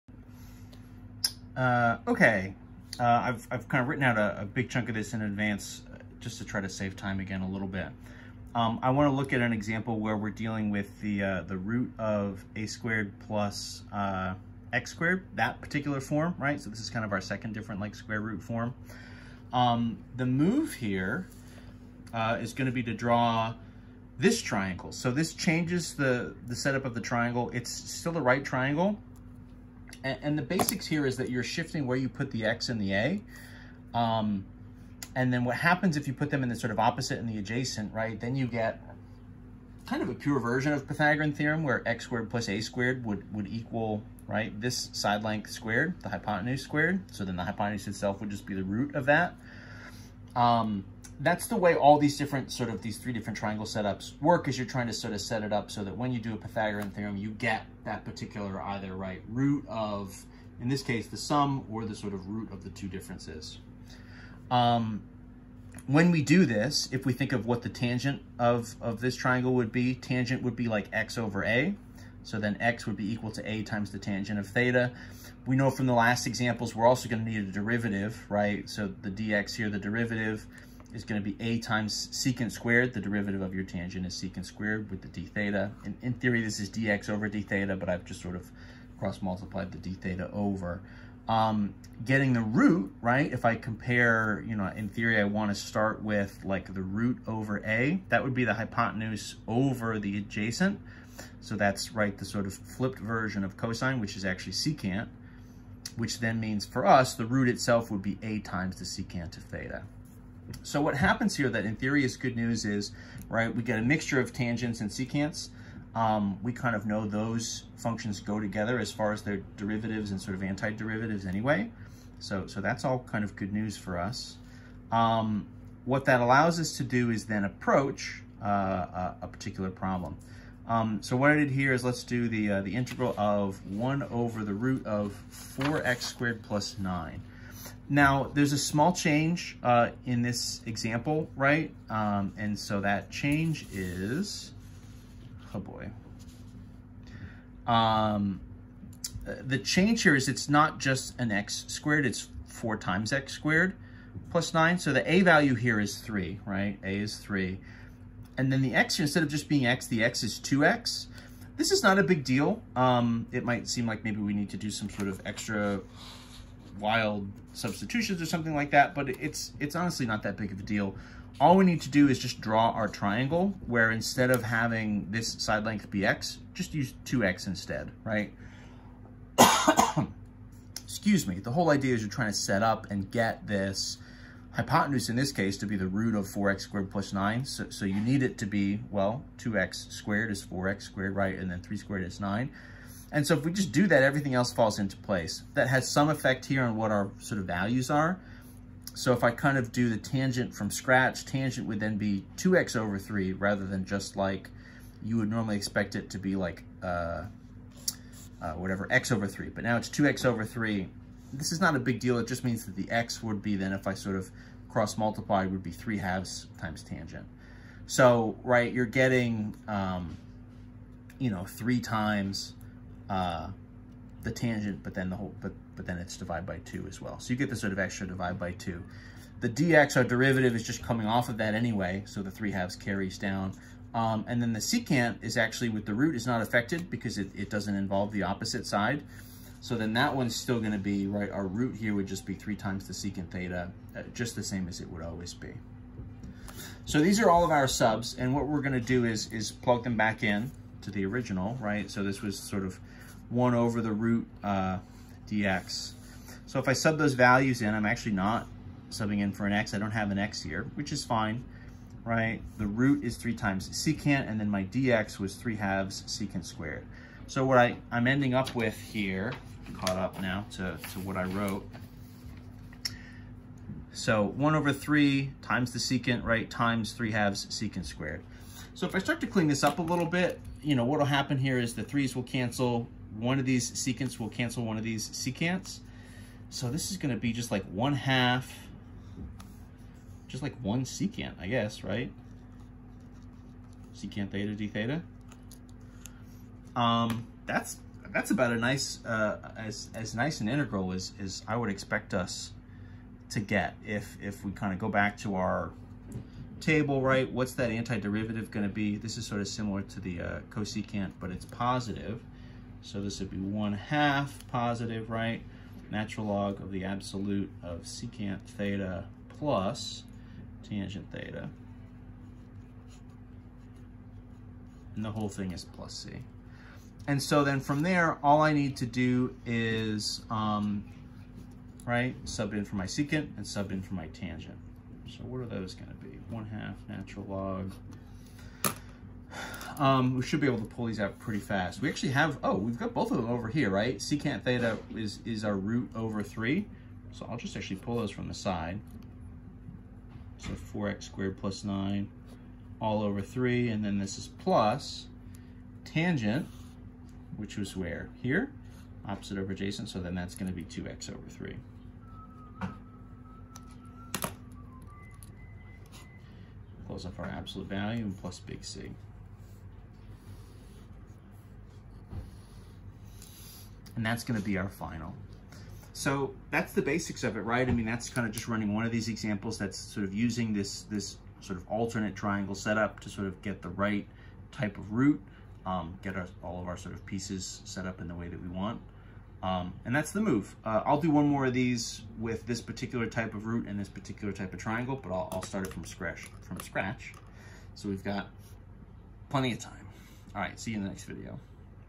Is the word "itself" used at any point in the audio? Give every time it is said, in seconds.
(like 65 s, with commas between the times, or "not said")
47 s, 107 s.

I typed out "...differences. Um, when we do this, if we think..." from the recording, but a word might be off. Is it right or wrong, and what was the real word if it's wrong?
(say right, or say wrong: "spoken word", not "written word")
right.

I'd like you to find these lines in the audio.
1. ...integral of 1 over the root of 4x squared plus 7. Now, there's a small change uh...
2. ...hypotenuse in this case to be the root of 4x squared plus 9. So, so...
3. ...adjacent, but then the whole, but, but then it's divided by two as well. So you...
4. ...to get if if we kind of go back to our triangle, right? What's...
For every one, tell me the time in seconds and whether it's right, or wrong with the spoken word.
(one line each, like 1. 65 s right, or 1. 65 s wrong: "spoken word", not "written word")
1. 132 s wrong: "9", not "7"
2. 184 s right
3. 224 s wrong: "tangent", not "adjacent"
4. 303 s wrong: "table", not "triangle".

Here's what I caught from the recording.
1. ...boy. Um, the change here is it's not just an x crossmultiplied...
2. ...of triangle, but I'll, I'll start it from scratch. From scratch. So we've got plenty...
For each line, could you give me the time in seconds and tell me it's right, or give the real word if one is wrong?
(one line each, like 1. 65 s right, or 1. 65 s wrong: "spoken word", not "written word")
1. 145 s wrong: "squared", not "crossmultiplied"
2. 394 s right.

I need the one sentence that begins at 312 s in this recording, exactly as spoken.
So this would be 1 half positive, right?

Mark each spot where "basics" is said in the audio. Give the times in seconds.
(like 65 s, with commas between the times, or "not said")
30 s, 376 s.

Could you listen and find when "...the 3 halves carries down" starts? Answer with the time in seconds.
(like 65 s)
232 s.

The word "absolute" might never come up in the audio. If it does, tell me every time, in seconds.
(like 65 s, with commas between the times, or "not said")
316 s, 367 s.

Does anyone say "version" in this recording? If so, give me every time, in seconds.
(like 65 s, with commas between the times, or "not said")
40 s, 102 s.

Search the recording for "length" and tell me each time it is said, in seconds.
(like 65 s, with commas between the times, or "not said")
45 s, 175 s.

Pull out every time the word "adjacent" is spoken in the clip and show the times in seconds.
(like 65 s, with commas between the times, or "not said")
37 s, 100 s, 359 s.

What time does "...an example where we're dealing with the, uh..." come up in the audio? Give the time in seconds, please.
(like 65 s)
9 s.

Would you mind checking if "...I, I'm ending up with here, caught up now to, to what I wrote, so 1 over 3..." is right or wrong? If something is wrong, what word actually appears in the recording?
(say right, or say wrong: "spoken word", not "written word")
right.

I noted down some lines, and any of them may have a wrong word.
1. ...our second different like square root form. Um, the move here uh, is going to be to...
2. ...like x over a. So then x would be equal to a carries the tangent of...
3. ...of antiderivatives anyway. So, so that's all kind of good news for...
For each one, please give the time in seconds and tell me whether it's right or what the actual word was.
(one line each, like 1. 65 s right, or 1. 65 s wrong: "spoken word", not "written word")
1. 17 s right
2. 70 s wrong: "times", not "carries"
3. 120 s right.